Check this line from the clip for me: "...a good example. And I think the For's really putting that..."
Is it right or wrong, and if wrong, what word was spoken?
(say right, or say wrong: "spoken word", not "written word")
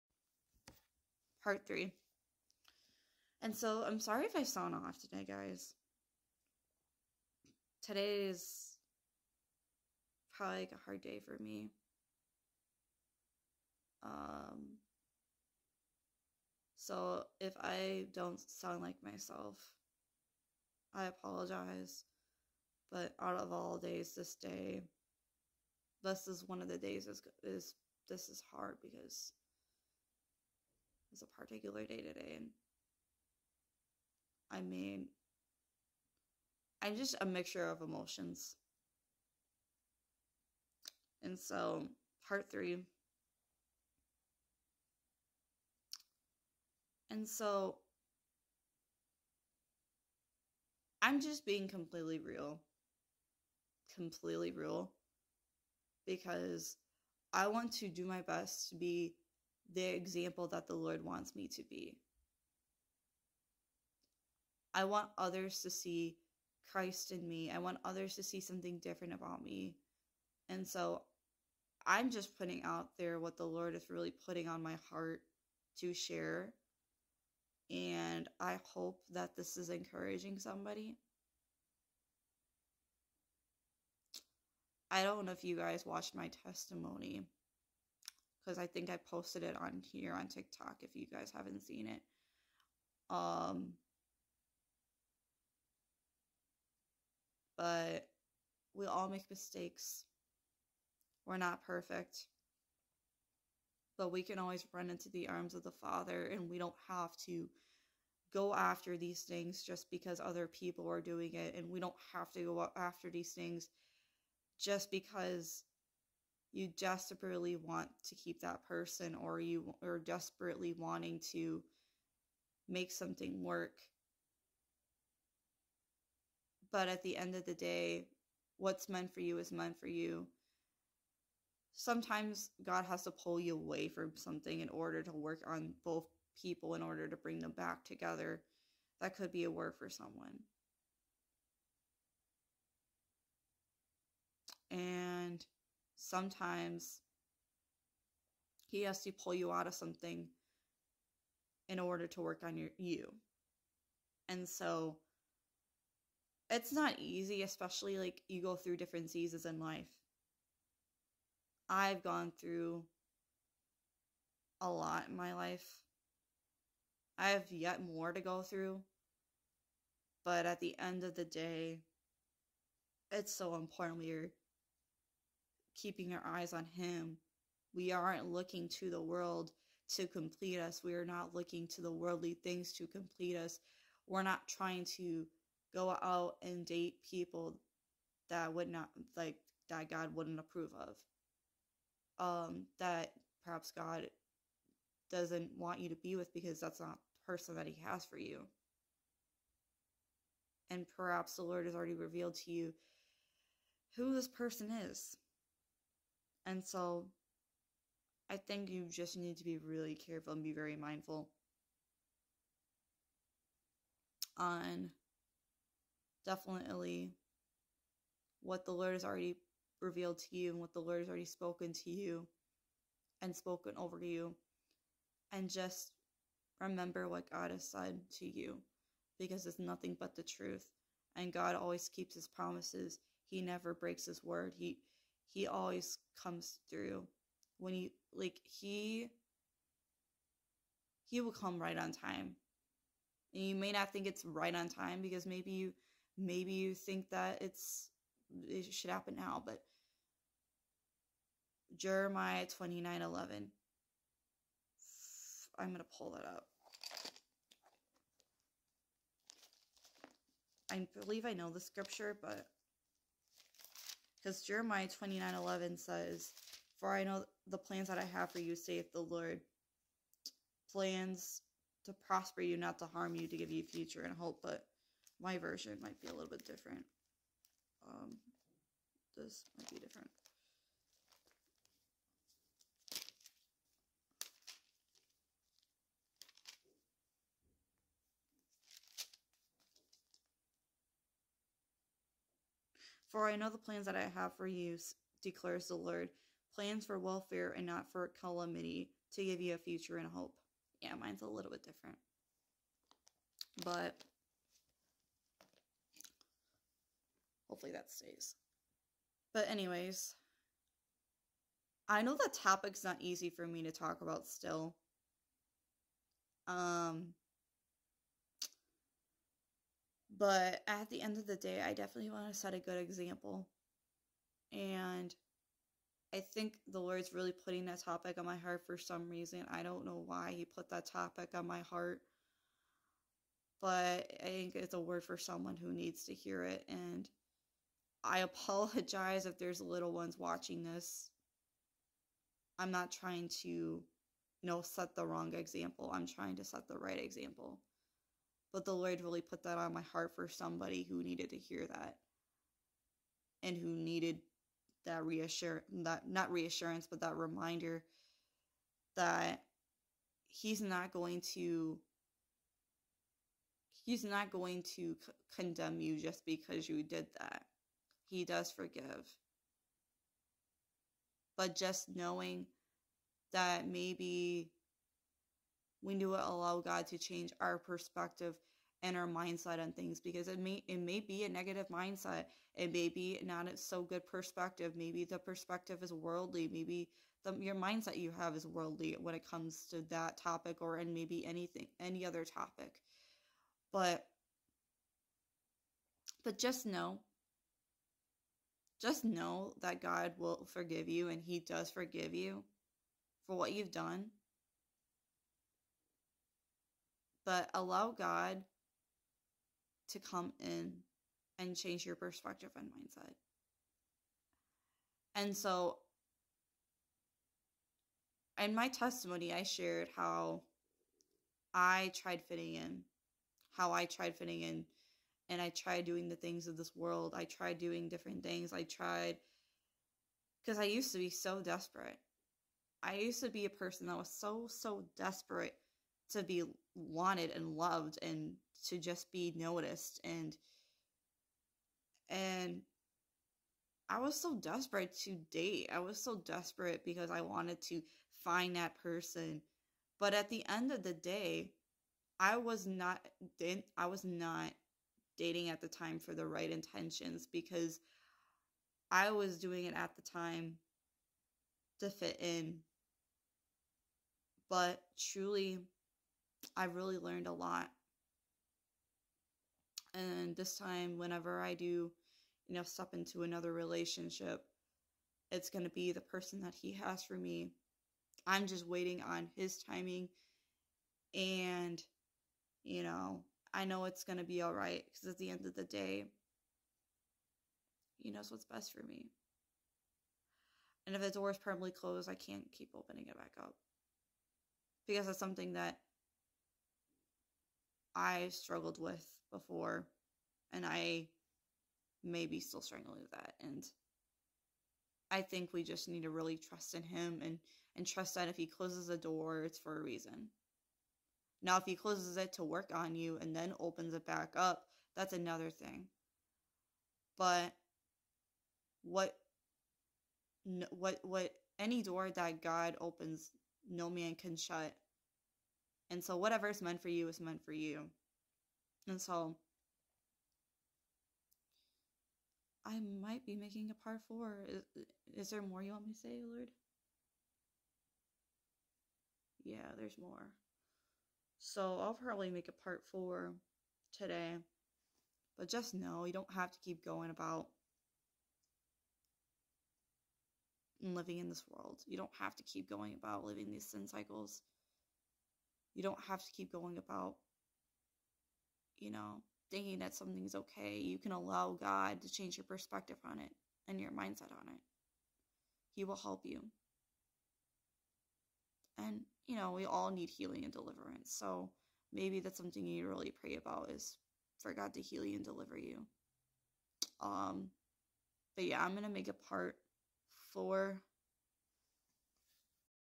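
wrong: "Lord", not "For".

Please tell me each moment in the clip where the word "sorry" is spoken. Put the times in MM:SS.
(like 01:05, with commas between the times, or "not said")
00:03.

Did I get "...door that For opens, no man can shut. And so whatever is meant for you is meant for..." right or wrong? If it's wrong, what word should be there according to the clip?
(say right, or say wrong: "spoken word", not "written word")
wrong: "God", not "For".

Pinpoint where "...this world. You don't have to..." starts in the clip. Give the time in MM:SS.
09:11.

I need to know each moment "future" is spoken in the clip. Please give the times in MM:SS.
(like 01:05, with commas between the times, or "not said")
04:33, 04:59.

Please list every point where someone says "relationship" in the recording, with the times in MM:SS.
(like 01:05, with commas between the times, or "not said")
07:53.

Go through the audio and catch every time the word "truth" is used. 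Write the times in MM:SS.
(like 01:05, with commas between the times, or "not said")
03:50.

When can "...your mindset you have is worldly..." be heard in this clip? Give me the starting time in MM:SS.
06:27.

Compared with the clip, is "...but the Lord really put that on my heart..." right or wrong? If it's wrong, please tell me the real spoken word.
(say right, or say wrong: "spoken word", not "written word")
right.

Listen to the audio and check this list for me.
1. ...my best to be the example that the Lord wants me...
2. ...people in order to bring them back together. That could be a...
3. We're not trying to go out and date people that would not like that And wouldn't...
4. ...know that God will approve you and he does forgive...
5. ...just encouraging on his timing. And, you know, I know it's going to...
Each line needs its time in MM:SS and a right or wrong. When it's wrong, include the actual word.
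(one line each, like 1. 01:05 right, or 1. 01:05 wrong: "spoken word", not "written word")
1. 00:58 right
2. 02:16 right
3. 03:04 wrong: "God", not "And"
4. 06:39 wrong: "forgive", not "approve"
5. 07:58 wrong: "waiting", not "encouraging".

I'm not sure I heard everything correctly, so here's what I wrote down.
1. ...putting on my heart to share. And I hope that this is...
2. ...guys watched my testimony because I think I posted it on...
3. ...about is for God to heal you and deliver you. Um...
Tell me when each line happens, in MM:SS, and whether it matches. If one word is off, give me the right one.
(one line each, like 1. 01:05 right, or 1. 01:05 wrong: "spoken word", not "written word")
1. 01:14 right
2. 01:25 right
3. 09:33 right.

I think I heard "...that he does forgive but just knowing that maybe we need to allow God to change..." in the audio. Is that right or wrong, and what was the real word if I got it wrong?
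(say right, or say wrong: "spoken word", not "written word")
right.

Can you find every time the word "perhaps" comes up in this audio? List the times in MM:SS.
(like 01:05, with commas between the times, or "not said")
03:13, 03:20.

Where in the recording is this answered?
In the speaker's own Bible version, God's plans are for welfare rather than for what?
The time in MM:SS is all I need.
04:58.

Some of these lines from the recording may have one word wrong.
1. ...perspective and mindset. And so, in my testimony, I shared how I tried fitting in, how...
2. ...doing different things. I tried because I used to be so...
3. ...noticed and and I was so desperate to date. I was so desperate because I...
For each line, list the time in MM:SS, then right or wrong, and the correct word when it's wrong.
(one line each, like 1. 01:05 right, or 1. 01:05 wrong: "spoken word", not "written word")
1. 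06:51 right
2. 07:07 right
3. 07:19 right.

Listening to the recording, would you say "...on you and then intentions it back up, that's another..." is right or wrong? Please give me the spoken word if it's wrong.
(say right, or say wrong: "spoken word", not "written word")
wrong: "opens", not "intentions".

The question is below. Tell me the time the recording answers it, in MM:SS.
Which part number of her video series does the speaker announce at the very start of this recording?
00:01.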